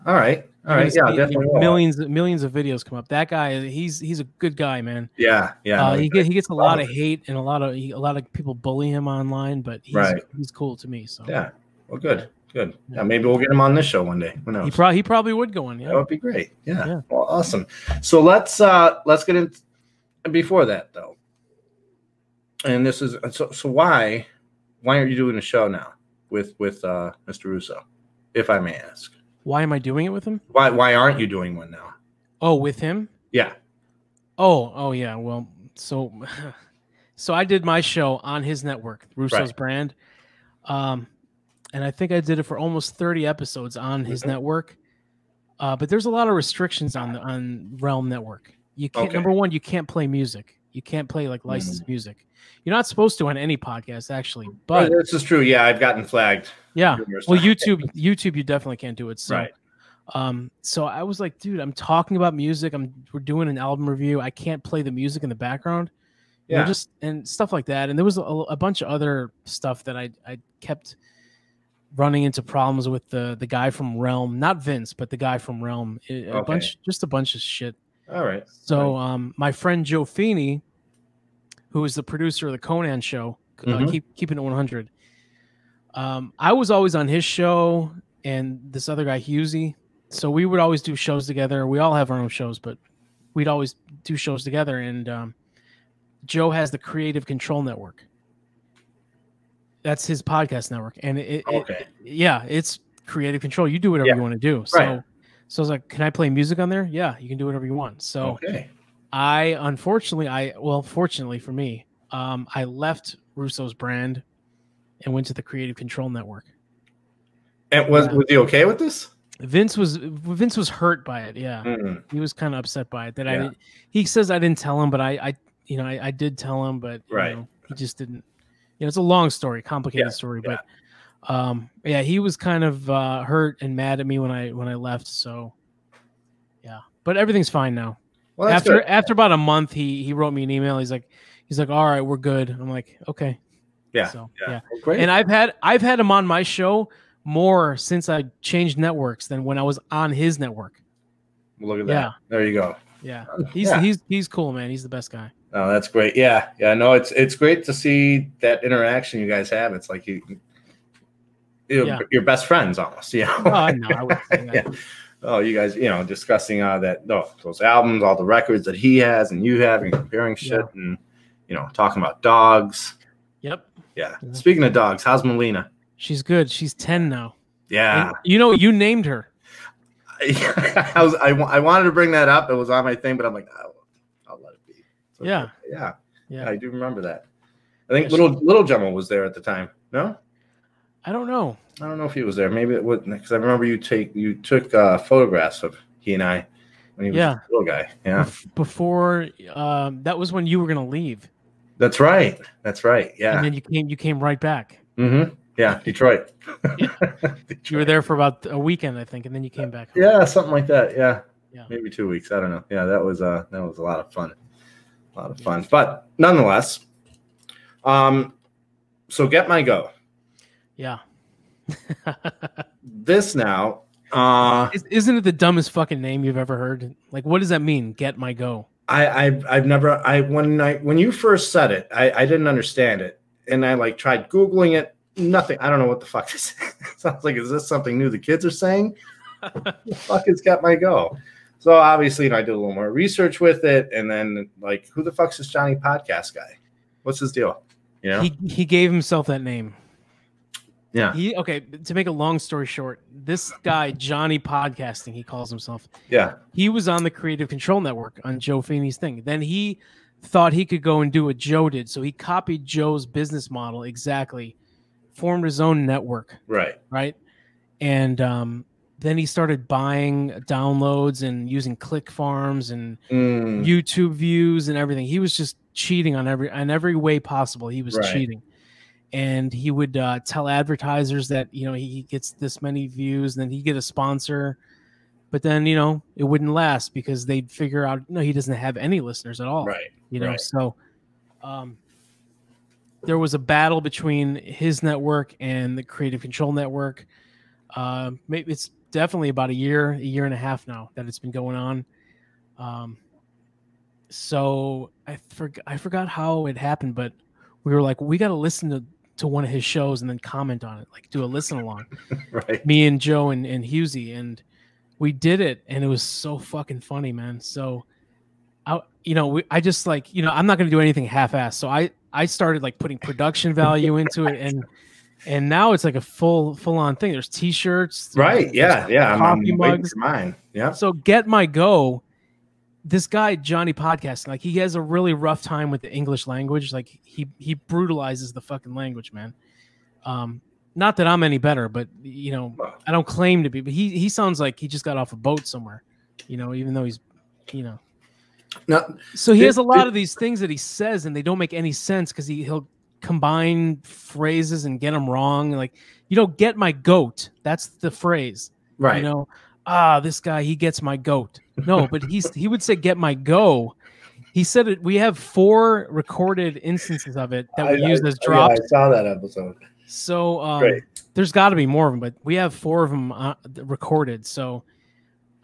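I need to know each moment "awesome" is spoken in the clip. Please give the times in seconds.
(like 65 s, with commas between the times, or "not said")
17 s.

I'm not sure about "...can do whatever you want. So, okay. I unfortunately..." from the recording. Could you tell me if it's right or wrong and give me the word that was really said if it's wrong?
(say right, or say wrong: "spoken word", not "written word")
right.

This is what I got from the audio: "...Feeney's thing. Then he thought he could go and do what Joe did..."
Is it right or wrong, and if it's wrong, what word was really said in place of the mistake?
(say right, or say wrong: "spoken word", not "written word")
right.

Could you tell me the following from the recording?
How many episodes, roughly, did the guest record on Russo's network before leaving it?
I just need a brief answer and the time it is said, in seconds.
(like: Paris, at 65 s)
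30, at 42 s.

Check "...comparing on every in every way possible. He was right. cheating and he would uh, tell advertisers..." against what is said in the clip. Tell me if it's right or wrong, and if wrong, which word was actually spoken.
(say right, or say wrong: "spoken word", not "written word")
wrong: "cheating", not "comparing".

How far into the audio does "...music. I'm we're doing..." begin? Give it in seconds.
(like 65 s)
62 s.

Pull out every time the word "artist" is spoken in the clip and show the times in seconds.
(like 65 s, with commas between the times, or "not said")
not said.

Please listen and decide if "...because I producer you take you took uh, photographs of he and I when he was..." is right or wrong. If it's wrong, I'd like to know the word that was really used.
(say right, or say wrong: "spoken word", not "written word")
wrong: "remember", not "producer".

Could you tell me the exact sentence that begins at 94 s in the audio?
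And um, Joe has the Creative Control Network.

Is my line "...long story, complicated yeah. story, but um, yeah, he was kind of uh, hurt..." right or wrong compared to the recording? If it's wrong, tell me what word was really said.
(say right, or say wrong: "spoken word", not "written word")
right.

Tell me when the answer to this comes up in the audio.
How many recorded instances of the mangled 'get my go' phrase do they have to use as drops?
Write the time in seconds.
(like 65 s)
365 s.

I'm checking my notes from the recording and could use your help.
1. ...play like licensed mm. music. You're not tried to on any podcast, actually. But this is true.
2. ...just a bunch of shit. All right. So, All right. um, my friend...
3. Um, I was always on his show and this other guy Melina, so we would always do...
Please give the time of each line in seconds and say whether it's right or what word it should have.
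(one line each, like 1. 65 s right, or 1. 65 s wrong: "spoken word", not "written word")
1. 51 s wrong: "supposed", not "tried"
2. 76 s right
3. 85 s wrong: "Husey", not "Melina".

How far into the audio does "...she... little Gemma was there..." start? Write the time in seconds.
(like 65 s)
188 s.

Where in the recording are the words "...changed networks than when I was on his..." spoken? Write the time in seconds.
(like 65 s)
148 s.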